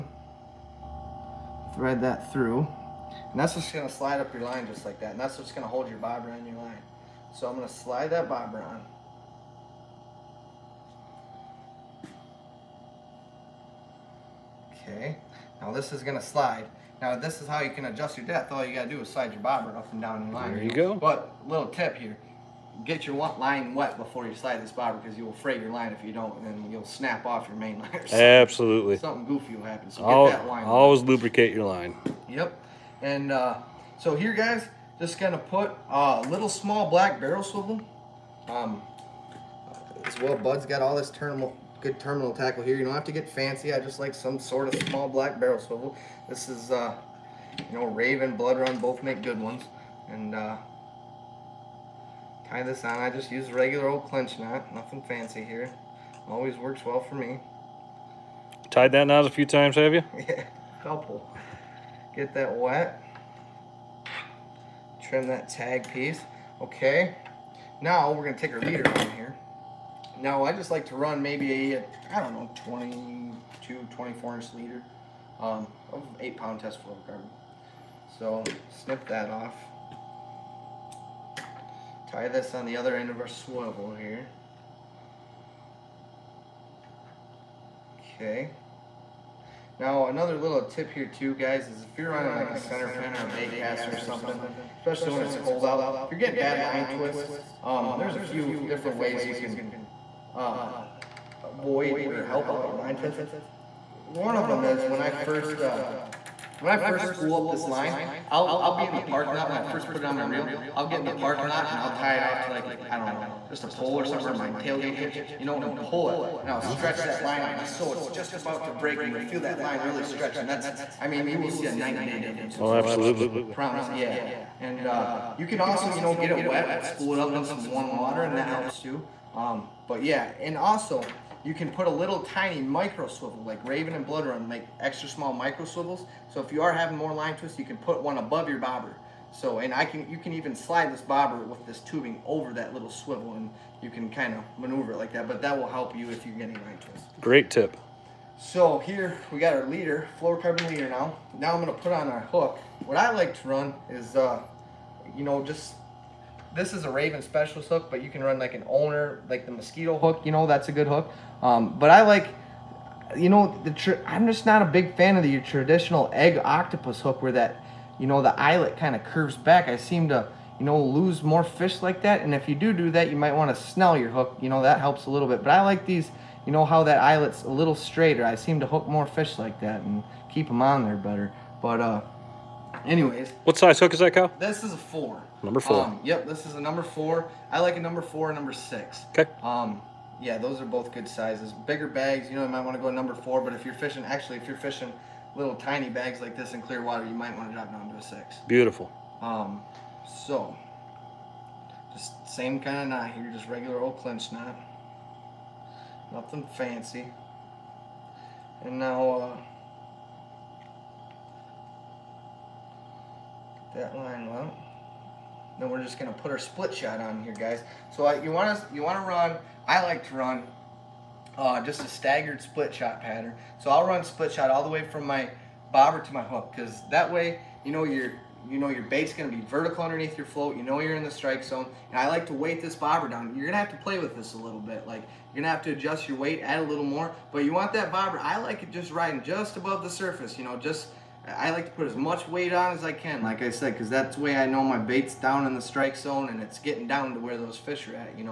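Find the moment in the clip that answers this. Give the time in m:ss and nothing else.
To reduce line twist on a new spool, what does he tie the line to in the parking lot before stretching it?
1:54.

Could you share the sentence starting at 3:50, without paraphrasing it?
You know you're in the strike zone, and I like to weight this bobber down.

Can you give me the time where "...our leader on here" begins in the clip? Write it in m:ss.
1:08.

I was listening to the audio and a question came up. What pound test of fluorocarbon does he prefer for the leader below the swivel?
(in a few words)
8 pound.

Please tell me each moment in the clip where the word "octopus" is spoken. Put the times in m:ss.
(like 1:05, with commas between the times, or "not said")
2:46.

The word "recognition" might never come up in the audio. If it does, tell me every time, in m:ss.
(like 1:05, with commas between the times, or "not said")
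not said.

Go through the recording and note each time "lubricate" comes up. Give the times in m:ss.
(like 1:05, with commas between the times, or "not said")
0:31.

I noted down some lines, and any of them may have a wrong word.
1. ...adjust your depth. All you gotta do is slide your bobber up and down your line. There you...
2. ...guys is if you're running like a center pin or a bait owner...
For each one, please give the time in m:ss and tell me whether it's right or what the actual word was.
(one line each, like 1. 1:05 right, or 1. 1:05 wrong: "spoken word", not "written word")
1. 0:17 right
2. 1:31 wrong: "caster", not "owner".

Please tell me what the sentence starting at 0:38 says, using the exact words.
Um, as well, Bud's got all this terminal, good terminal tackle here.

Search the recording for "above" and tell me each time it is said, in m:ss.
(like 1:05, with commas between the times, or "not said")
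2:18, 3:59.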